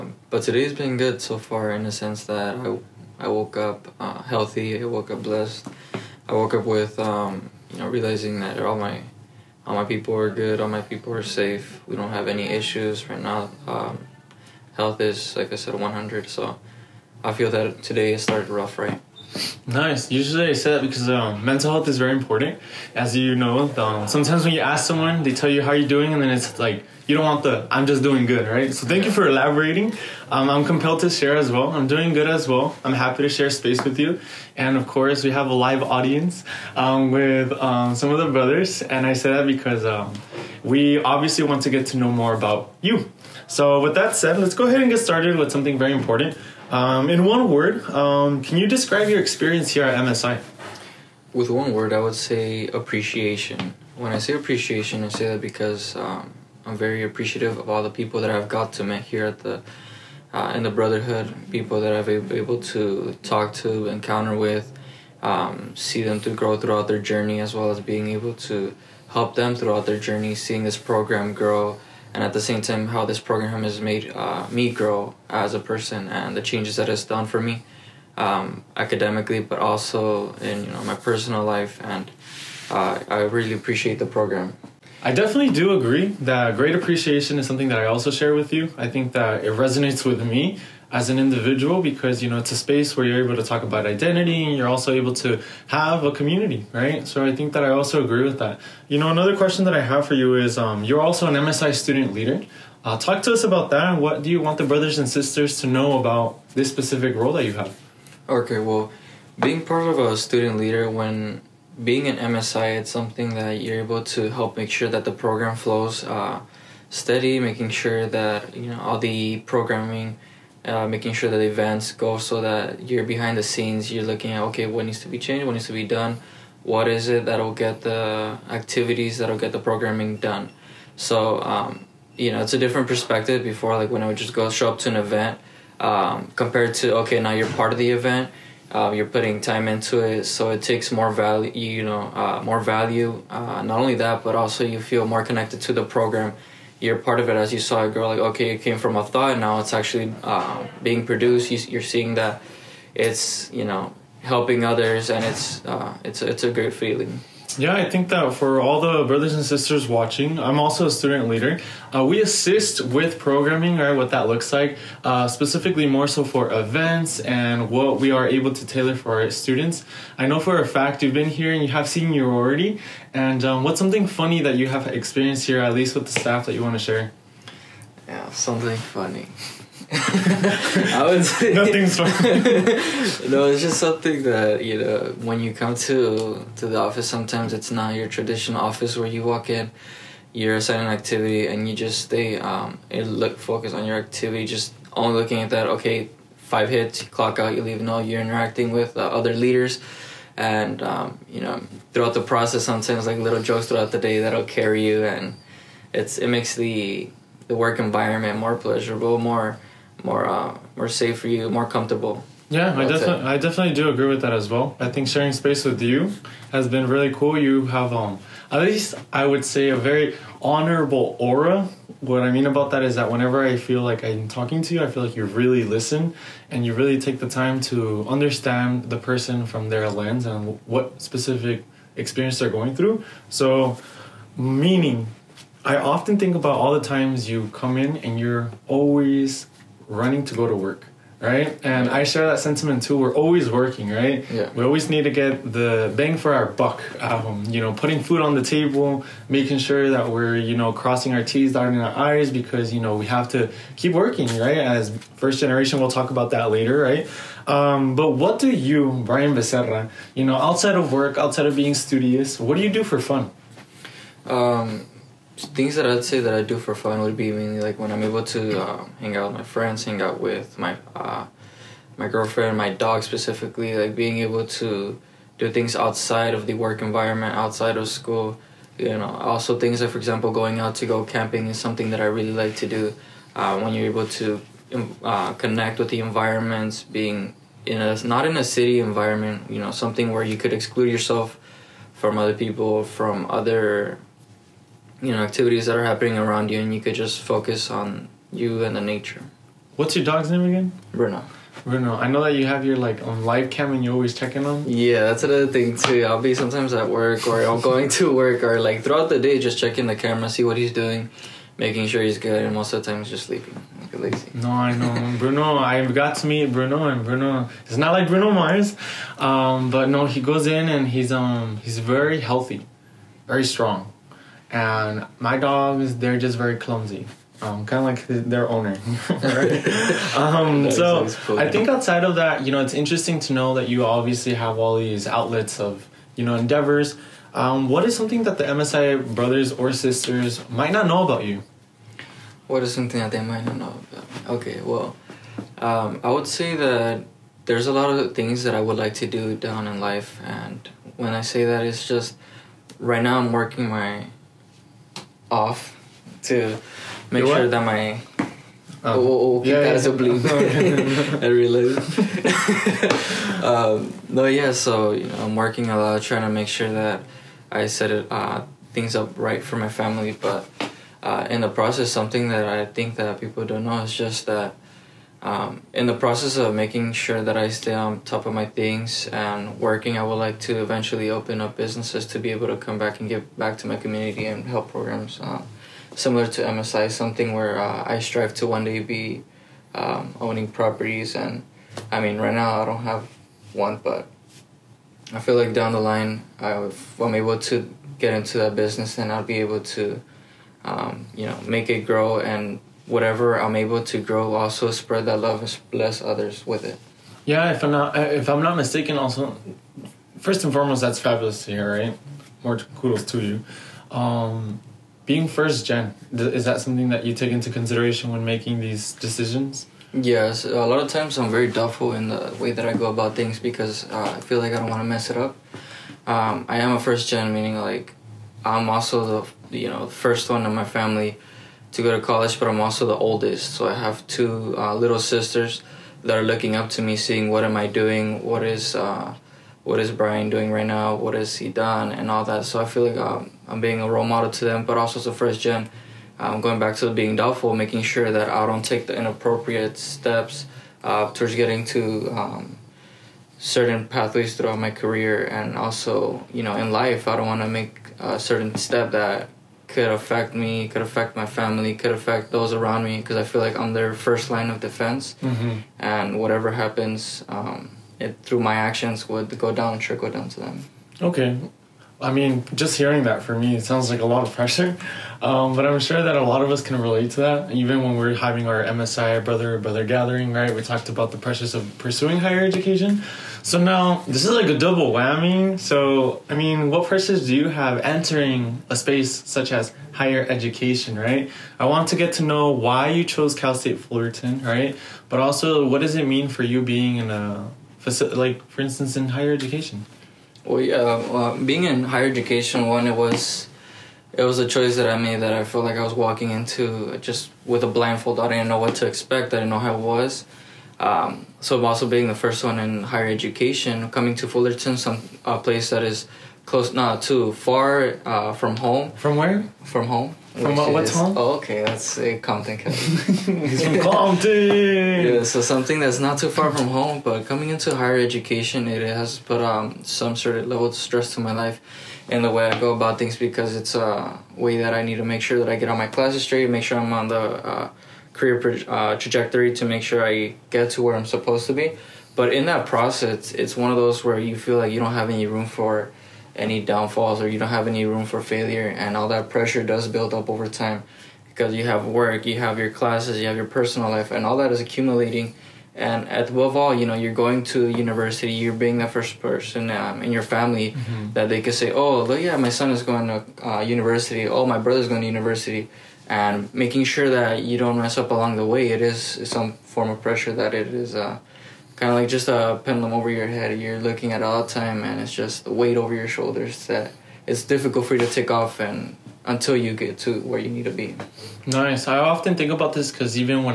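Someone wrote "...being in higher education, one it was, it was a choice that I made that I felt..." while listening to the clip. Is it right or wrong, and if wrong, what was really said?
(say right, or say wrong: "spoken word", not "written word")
right.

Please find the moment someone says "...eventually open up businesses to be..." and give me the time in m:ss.
6:20.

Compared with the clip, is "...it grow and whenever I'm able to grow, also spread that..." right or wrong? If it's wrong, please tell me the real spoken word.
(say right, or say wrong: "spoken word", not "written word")
wrong: "whatever", not "whenever".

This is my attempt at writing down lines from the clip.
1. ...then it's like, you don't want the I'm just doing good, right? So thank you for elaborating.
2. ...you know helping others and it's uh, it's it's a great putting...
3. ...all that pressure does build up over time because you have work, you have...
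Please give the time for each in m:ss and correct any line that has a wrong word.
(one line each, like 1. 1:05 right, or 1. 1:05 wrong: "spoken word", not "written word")
1. 0:26 right
2. 2:33 wrong: "feeling", not "putting"
3. 9:08 right.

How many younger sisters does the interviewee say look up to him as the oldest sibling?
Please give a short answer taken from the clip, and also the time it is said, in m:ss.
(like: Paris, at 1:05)
2, at 7:14.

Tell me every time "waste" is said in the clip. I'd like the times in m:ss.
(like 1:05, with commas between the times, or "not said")
not said.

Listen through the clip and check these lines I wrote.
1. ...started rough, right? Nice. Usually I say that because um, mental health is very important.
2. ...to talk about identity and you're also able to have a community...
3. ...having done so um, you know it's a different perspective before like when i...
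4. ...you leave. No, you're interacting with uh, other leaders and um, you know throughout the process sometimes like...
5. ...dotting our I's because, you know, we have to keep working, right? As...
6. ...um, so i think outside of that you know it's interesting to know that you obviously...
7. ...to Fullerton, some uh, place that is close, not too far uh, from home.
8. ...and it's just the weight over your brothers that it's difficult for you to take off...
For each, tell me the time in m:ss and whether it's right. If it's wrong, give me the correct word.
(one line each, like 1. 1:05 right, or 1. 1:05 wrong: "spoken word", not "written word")
1. 0:18 right
2. 1:33 right
3. 2:09 wrong: "programming", not "having"
4. 3:17 right
5. 4:11 right
6. 5:30 right
7. 8:34 right
8. 9:34 wrong: "shoulders", not "brothers".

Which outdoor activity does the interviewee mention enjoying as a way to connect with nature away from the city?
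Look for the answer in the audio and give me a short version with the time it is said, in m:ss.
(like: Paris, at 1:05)
Camping, at 4:40.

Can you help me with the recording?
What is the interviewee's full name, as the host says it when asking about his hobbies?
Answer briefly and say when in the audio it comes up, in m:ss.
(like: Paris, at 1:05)
Brian Becerra, at 4:19.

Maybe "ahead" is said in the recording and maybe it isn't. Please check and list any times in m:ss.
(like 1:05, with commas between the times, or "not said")
0:44.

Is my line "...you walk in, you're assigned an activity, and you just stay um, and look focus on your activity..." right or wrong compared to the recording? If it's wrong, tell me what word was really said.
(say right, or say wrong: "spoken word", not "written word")
right.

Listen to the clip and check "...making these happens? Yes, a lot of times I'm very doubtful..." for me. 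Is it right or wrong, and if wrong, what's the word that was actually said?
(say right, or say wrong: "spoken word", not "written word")
wrong: "decisions", not "happens".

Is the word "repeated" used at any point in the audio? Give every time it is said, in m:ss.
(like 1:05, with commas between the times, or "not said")
not said.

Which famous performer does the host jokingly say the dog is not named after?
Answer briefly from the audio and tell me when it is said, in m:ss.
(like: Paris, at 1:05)
Bruno Mars, at 5:18.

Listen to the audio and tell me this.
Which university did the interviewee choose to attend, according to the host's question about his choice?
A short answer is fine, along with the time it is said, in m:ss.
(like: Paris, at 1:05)
Cal State Fullerton, at 8:13.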